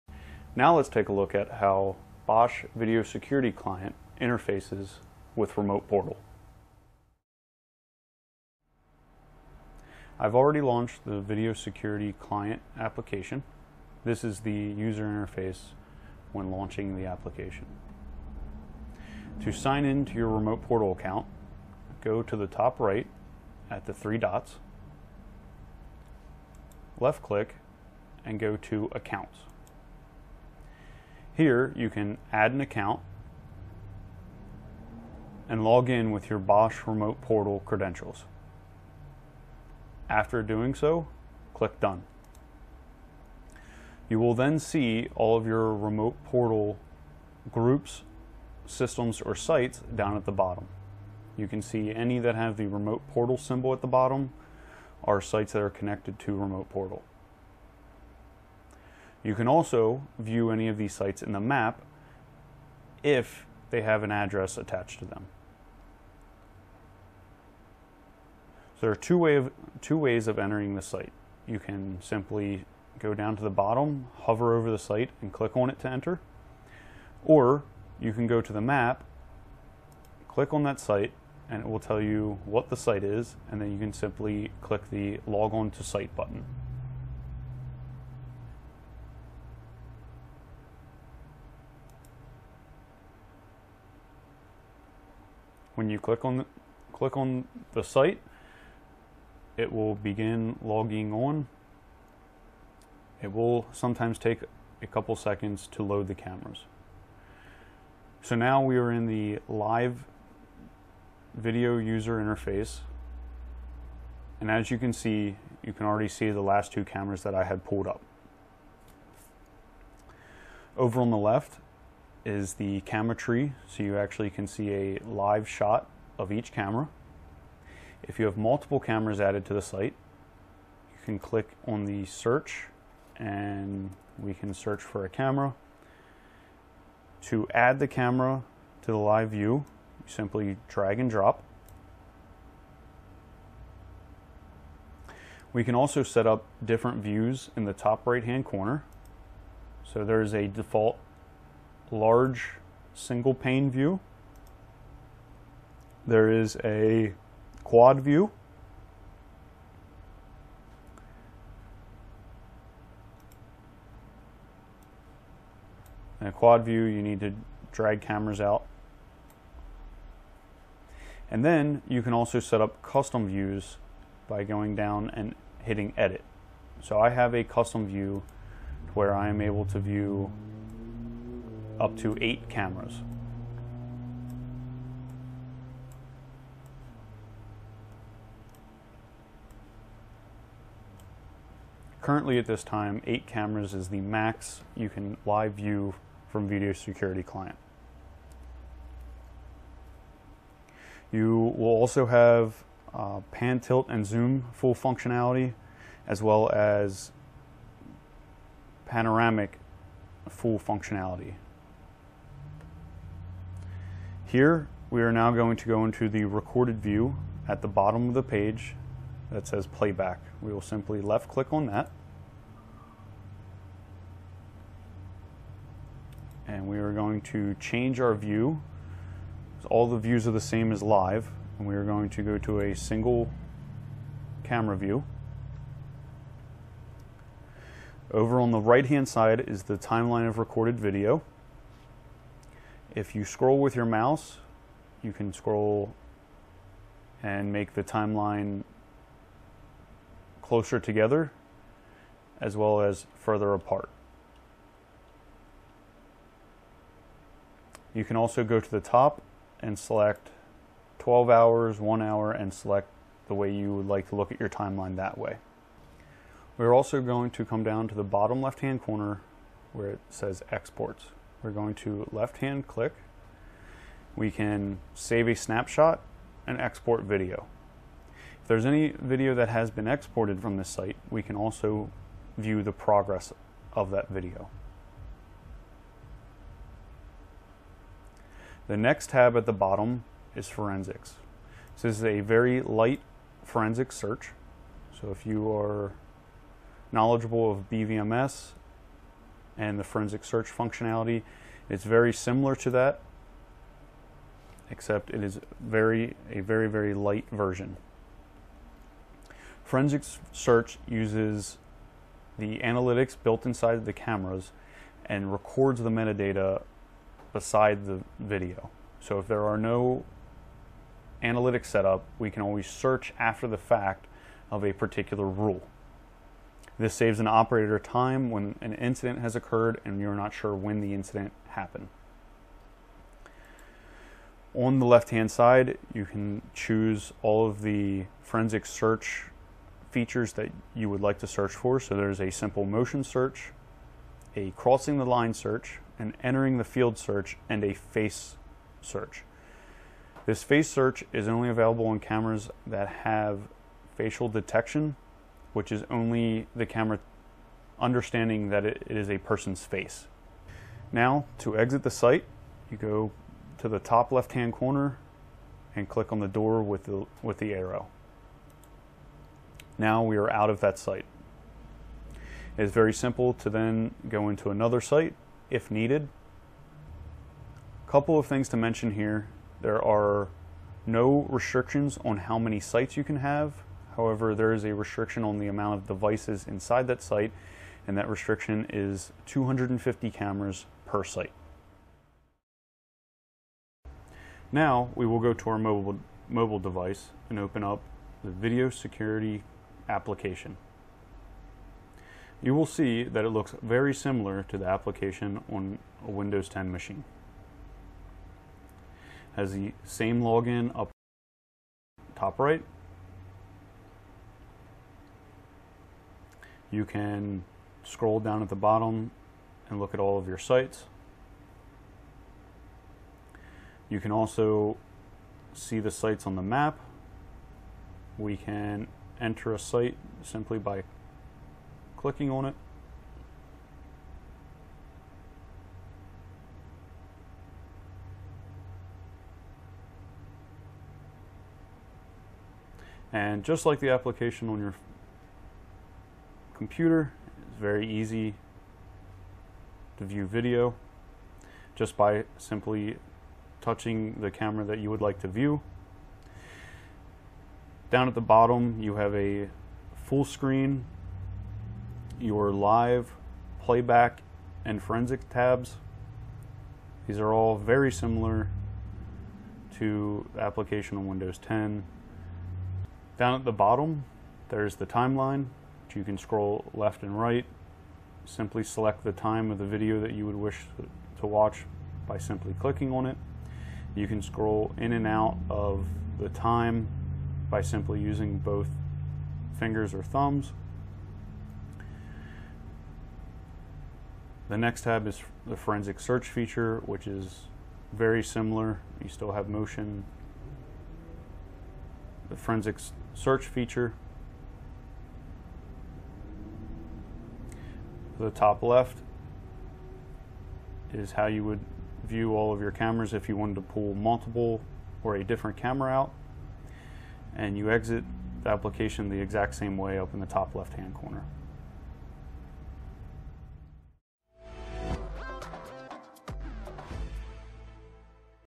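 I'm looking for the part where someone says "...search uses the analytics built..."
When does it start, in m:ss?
5:10.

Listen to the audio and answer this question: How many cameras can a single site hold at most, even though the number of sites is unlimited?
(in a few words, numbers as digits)
250.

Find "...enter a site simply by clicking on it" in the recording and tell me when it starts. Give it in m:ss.
7:09.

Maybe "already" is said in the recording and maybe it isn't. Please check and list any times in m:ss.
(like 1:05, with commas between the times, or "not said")
0:10, 1:55.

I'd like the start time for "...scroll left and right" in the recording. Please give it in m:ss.
7:56.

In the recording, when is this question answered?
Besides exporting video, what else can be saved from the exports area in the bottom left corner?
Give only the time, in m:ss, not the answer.
4:35.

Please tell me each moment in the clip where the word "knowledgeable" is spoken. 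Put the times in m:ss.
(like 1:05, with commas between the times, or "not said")
4:56.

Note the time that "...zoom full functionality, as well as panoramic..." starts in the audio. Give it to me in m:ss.
3:24.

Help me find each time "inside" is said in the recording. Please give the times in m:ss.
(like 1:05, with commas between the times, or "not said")
5:13, 6:26.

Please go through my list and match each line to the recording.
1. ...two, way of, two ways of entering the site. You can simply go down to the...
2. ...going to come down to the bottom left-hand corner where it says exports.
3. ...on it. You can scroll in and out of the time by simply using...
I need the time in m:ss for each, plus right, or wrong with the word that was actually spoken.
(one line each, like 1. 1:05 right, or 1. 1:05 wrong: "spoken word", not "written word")
1. 1:08 right
2. 4:27 right
3. 8:02 right.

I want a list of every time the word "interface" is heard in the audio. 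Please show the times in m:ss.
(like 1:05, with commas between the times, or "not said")
0:04, 0:15, 1:52.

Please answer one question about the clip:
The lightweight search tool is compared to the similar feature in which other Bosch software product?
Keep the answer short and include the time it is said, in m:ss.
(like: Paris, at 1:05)
BVMS, at 4:57.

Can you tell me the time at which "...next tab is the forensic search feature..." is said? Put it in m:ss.
8:14.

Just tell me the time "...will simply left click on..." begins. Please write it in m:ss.
3:40.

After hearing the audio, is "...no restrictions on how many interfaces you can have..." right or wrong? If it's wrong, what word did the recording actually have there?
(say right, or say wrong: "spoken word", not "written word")
wrong: "sites", not "interfaces".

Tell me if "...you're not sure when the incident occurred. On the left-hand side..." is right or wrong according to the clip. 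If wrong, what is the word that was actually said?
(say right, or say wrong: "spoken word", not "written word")
wrong: "happened", not "occurred".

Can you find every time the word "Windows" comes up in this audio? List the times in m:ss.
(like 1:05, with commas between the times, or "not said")
6:46, 7:51.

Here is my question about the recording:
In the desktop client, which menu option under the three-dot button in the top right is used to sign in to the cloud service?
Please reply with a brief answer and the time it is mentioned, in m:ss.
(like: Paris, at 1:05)
Accounts, at 0:28.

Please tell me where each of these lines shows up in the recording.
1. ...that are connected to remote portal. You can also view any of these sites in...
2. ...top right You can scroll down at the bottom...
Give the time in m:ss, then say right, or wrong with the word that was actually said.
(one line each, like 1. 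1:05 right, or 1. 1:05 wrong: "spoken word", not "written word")
1. 0:55 right
2. 6:52 right.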